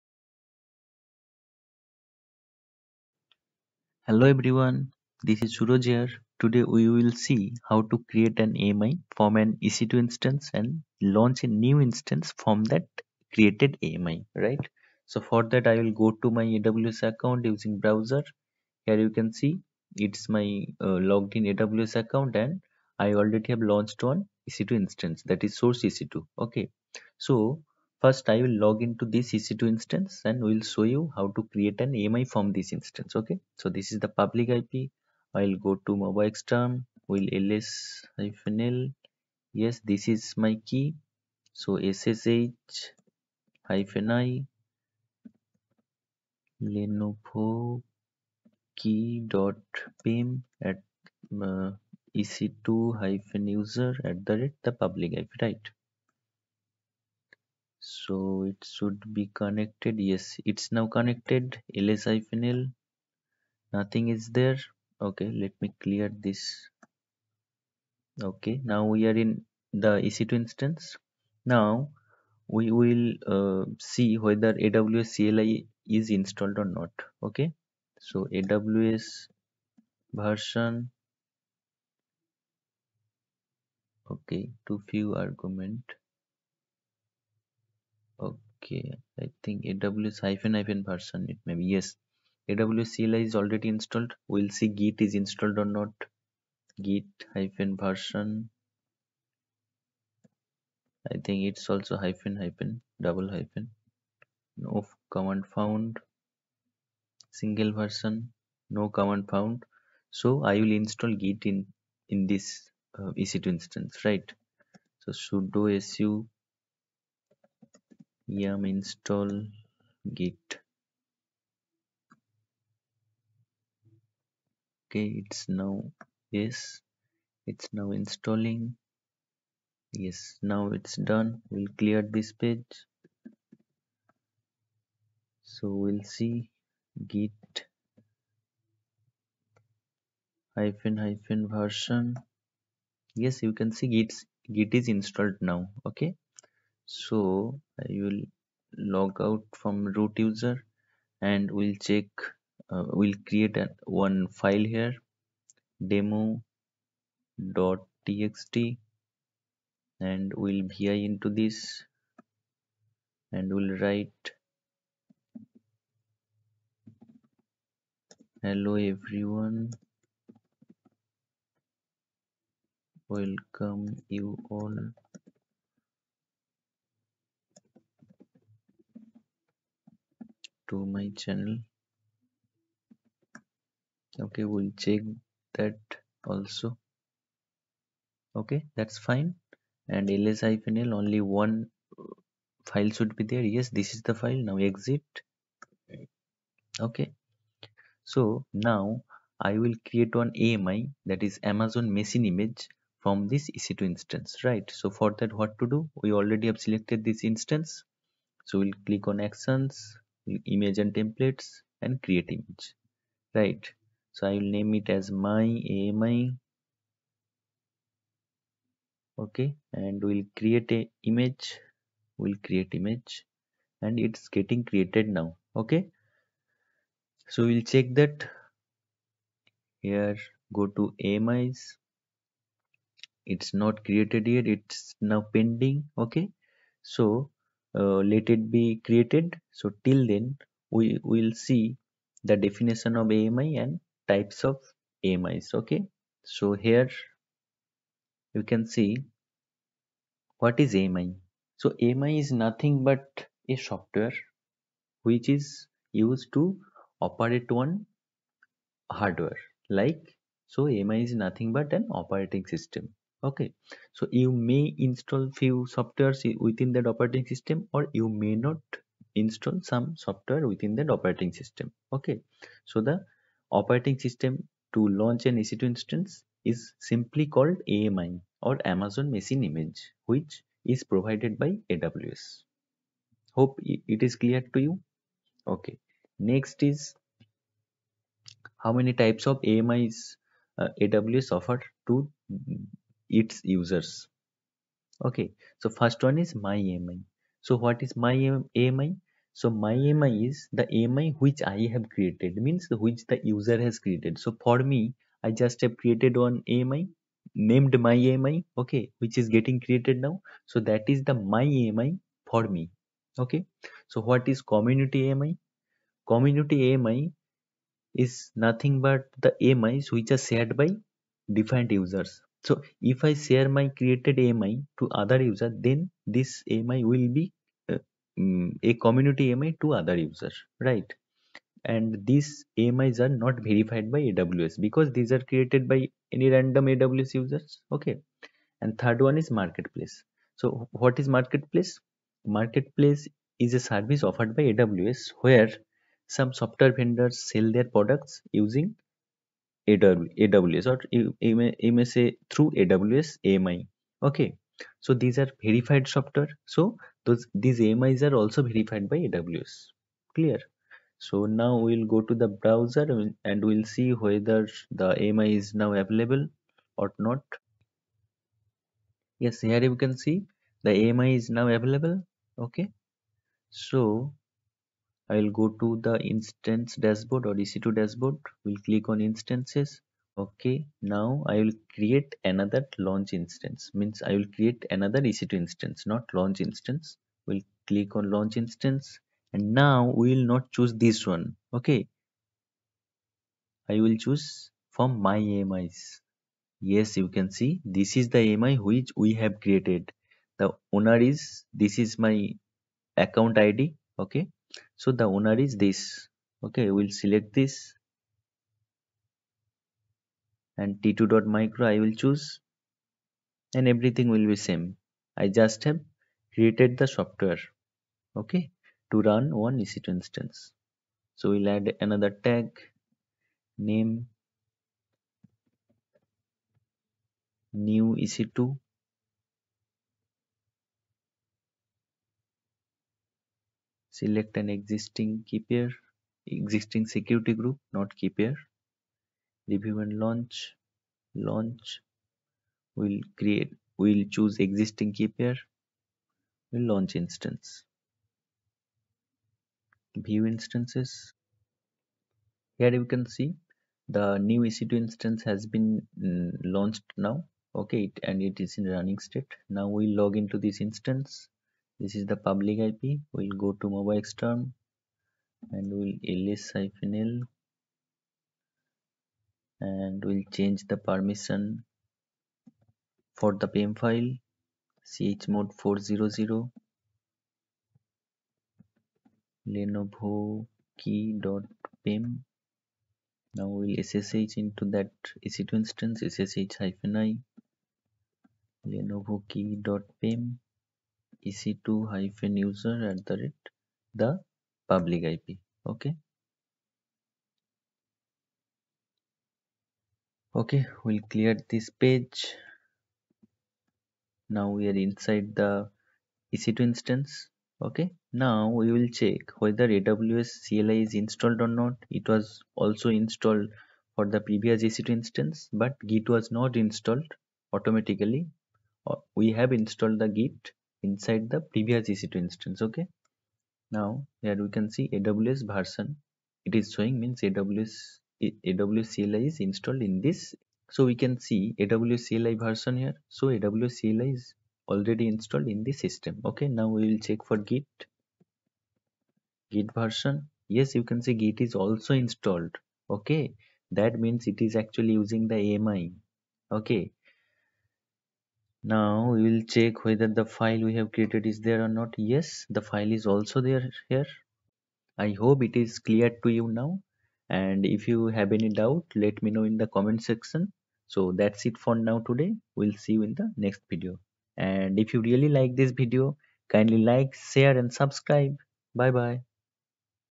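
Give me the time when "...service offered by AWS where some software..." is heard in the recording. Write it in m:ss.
5:43.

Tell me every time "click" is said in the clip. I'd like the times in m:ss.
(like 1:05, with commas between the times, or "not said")
3:28, 6:18, 6:27.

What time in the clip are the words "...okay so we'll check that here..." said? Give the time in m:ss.
3:45.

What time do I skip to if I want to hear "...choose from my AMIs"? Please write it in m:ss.
6:33.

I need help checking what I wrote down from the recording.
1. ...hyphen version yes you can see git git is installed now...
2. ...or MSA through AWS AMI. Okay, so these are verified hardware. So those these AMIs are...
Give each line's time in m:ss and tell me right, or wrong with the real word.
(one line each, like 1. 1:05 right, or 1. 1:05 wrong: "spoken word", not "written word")
1. 2:20 right
2. 5:50 wrong: "software", not "hardware".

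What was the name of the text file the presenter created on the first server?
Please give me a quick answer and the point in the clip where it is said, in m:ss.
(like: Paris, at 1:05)
demo.txt, at 2:35.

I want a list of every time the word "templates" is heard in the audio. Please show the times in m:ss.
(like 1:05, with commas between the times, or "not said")
3:30.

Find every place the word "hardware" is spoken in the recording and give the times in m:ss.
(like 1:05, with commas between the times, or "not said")
4:18.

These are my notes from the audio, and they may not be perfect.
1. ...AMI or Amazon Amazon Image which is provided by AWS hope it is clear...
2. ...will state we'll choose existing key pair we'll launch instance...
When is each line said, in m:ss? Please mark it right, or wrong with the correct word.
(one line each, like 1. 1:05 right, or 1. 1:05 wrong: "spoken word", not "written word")
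1. 4:37 wrong: "Machine", not "Amazon"
2. 7:22 wrong: "create", not "state".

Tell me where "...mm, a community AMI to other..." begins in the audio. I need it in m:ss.
5:28.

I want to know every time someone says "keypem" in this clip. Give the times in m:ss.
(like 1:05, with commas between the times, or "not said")
8:00, 8:09.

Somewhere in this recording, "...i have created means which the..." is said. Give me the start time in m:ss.
5:01.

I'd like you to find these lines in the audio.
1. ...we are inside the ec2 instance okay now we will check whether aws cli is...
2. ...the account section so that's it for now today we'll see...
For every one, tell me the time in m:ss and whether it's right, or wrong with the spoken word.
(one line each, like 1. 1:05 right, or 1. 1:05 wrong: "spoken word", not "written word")
1. 8:24 right
2. 9:19 wrong: "comment", not "account".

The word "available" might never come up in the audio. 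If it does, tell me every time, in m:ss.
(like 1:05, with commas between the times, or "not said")
6:05, 6:11.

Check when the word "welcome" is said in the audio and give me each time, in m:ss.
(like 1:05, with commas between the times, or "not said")
2:53.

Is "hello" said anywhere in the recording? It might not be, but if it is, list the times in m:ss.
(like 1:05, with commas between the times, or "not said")
0:04, 2:48.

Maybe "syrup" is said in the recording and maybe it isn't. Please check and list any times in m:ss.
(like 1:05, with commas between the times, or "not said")
not said.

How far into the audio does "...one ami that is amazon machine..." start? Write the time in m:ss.
3:20.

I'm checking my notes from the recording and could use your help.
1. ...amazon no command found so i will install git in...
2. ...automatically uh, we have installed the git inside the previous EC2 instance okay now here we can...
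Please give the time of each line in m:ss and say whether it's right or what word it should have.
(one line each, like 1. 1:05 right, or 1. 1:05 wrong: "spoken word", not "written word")
1. 1:47 wrong: "version", not "amazon"
2. 8:37 right.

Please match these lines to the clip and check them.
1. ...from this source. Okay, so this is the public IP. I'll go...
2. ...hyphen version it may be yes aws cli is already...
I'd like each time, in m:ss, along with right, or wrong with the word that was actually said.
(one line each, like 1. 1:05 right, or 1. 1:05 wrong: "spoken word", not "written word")
1. 0:32 wrong: "instance", not "source"
2. 1:30 right.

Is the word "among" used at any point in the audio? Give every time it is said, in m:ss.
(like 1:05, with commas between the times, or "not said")
not said.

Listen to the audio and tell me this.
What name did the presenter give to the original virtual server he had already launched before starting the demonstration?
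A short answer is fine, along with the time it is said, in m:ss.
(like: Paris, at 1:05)
source EC2, at 0:25.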